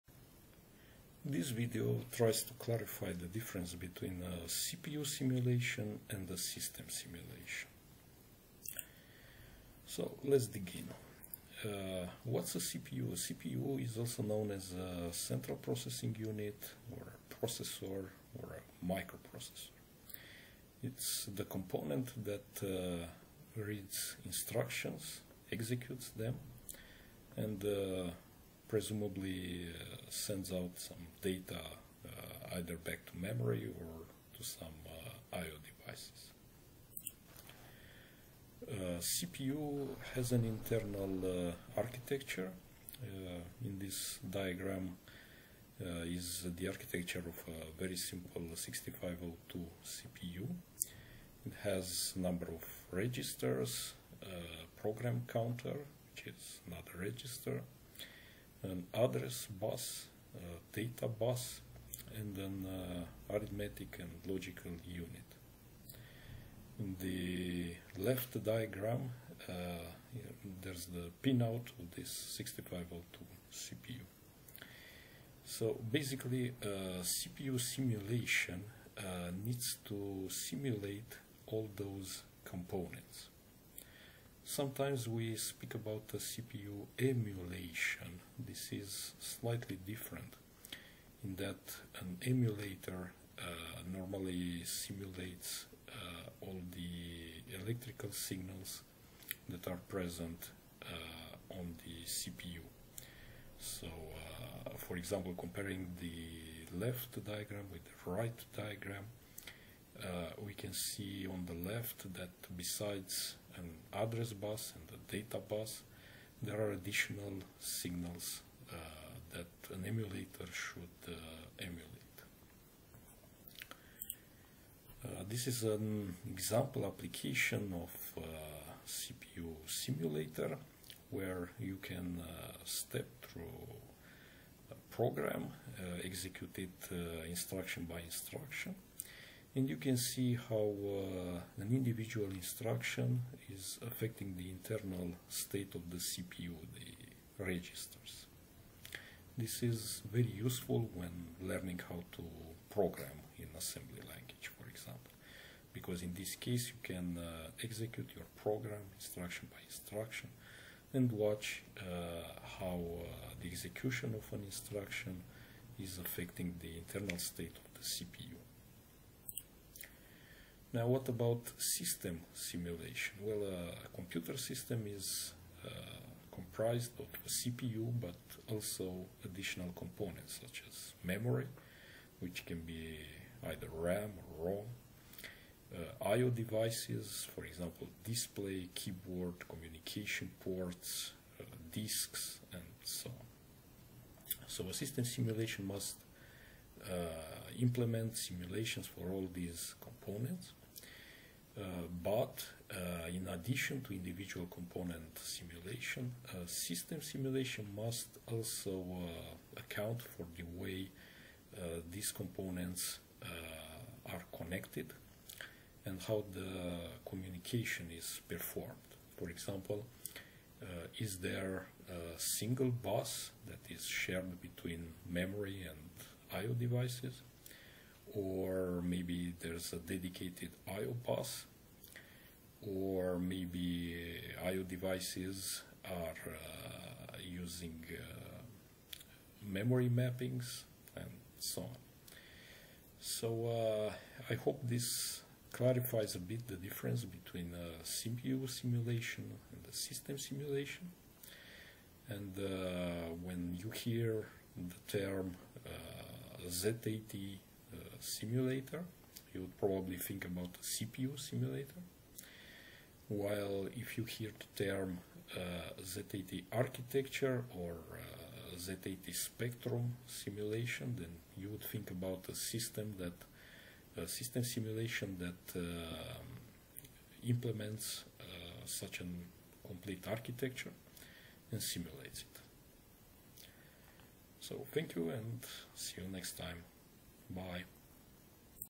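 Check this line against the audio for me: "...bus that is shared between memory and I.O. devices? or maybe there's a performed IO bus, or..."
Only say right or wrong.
wrong.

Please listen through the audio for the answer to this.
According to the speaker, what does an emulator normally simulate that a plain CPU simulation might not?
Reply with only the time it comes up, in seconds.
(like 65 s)
97 s.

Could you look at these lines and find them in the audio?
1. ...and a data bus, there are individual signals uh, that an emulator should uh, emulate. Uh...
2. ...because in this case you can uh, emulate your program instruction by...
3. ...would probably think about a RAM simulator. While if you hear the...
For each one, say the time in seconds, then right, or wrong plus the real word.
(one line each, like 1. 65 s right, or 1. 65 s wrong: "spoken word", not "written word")
1. 114 s wrong: "additional", not "individual"
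2. 155 s wrong: "execute", not "emulate"
3. 259 s wrong: "CPU", not "RAM".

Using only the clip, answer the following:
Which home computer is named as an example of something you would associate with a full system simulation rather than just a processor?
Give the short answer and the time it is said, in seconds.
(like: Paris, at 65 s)
ZX Spectrum, at 268 s.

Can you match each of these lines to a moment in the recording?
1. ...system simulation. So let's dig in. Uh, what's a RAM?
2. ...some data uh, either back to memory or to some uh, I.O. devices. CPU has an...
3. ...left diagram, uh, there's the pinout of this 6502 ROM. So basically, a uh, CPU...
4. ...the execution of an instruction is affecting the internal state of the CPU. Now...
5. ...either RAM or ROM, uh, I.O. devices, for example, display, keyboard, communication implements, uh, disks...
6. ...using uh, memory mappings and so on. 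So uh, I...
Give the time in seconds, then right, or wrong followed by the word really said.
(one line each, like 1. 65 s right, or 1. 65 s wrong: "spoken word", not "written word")
1. 6 s wrong: "CPU", not "RAM"
2. 30 s right
3. 68 s wrong: "CPU", not "ROM"
4. 163 s right
5. 183 s wrong: "ports", not "implements"
6. 237 s right.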